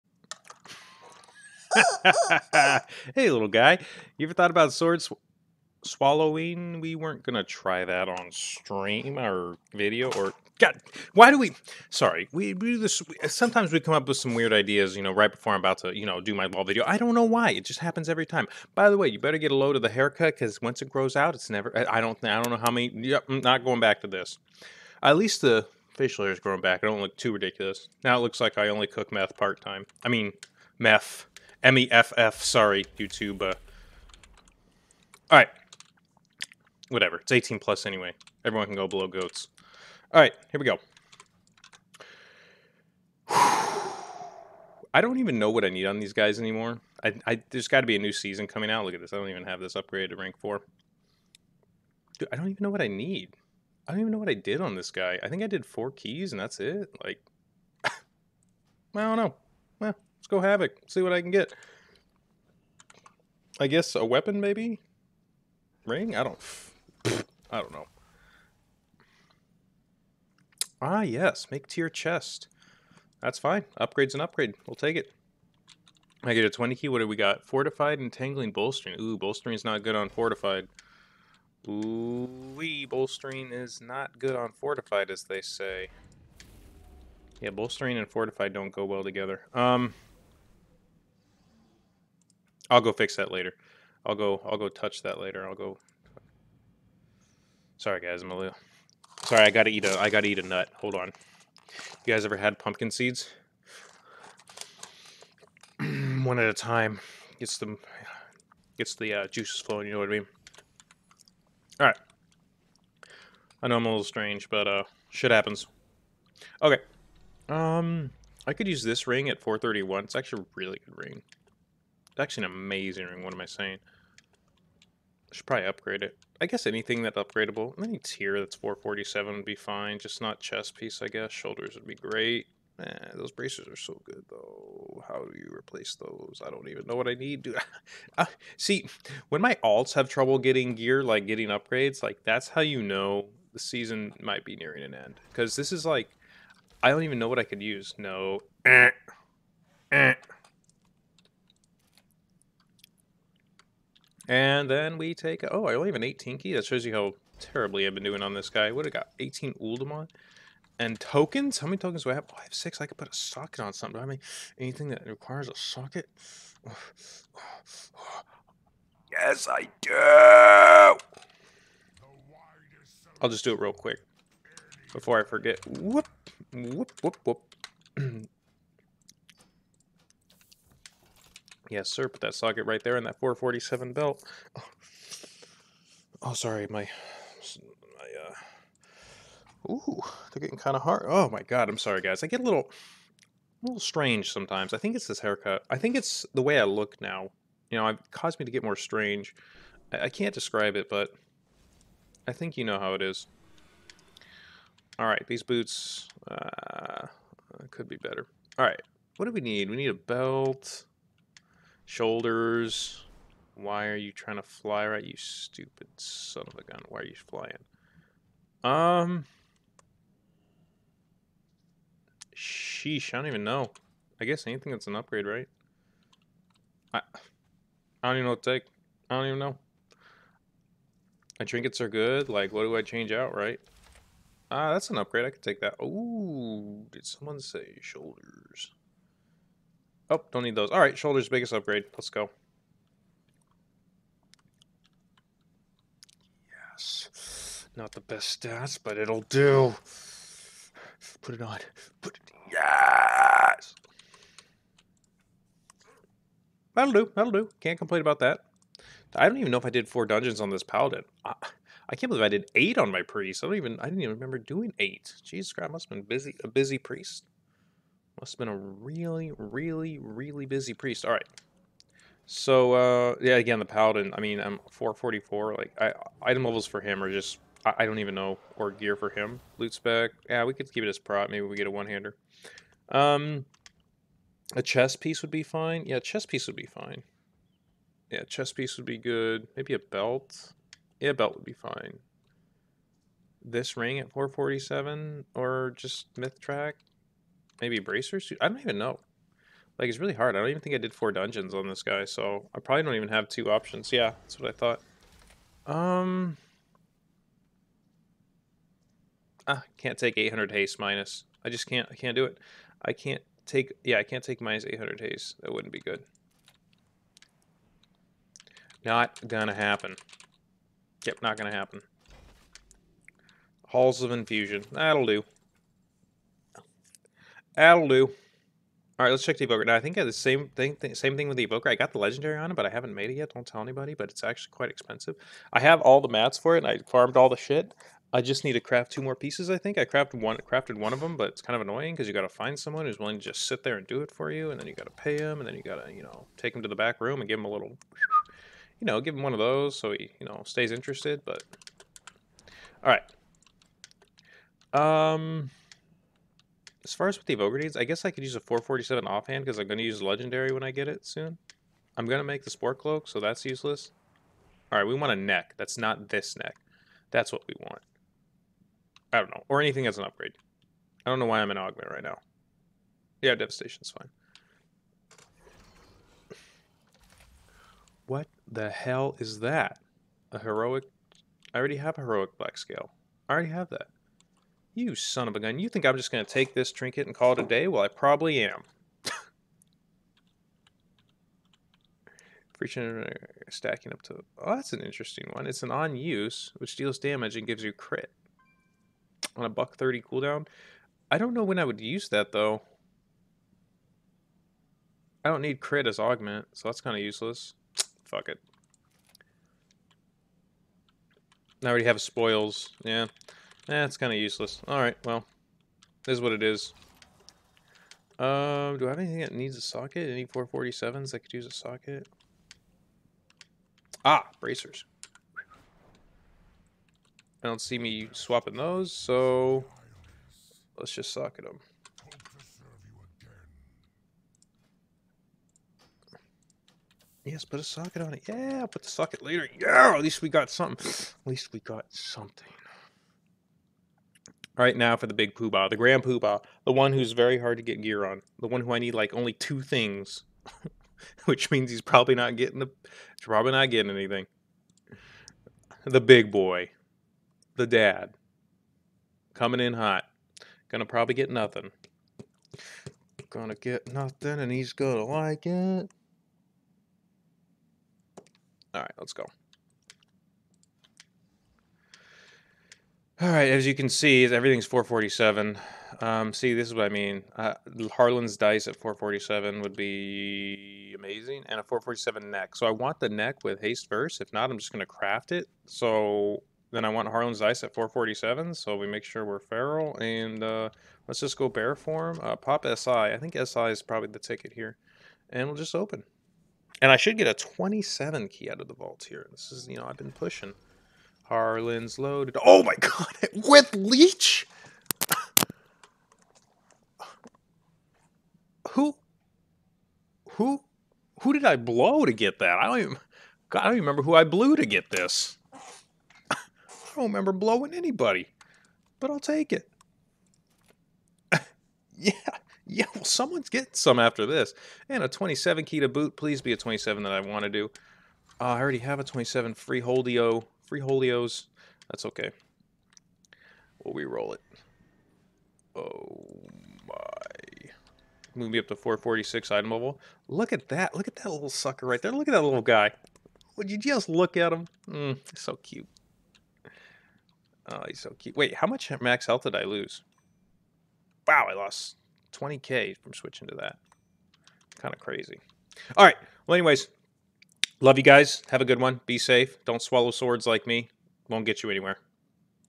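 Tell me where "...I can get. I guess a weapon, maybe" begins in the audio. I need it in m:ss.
1:01.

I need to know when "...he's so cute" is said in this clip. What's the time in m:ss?
9:07.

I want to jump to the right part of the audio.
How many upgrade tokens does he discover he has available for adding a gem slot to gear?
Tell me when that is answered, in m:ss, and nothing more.
2:42.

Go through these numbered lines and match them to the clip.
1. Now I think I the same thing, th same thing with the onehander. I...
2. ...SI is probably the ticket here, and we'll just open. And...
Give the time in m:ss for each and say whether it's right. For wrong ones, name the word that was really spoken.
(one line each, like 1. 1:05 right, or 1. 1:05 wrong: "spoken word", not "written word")
1. 5:29 wrong: "evoker", not "onehander"
2. 8:13 right.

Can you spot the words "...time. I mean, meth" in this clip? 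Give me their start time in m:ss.
0:29.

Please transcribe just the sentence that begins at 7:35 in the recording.
The big boy, the dad, coming in hot, gonna probably get nothing.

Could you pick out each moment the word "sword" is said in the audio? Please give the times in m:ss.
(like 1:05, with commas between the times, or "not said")
0:04, 9:20.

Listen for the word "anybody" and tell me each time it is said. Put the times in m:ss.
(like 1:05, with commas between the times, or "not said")
5:33, 8:37.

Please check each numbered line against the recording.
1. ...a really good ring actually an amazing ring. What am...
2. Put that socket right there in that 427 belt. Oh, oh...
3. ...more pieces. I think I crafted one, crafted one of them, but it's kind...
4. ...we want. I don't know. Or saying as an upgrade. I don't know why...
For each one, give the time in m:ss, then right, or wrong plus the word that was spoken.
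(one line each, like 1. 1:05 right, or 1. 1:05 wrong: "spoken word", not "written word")
1. 2:00 right
2. 3:02 wrong: "447", not "427"
3. 5:39 right
4. 6:07 wrong: "anything", not "saying".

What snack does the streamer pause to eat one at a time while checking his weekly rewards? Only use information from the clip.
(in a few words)
Pumpkin seeds.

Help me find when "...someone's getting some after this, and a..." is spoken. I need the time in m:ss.
8:43.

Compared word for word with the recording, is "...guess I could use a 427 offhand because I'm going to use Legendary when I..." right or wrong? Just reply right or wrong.
wrong.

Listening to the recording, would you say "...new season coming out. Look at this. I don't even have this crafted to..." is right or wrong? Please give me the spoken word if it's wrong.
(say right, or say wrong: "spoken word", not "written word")
wrong: "upgraded", not "crafted".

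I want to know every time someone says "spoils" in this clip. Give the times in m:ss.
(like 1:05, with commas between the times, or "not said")
6:52.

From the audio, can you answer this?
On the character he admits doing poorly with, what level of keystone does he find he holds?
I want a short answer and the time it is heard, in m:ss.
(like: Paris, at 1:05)
18, at 2:36.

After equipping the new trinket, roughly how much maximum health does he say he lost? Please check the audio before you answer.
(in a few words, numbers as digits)
20k.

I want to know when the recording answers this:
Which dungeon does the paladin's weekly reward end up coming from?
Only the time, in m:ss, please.
5:23.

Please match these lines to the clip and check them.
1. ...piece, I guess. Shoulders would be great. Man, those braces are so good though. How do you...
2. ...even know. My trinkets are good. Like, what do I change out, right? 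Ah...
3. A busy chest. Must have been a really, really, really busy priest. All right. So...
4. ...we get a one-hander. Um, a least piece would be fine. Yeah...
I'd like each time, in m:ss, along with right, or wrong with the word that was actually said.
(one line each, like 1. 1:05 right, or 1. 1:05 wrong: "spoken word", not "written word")
1. 2:10 right
2. 3:49 right
3. 4:26 wrong: "priest", not "chest"
4. 4:41 wrong: "chest", not "least".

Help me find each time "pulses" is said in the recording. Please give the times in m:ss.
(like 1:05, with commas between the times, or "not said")
not said.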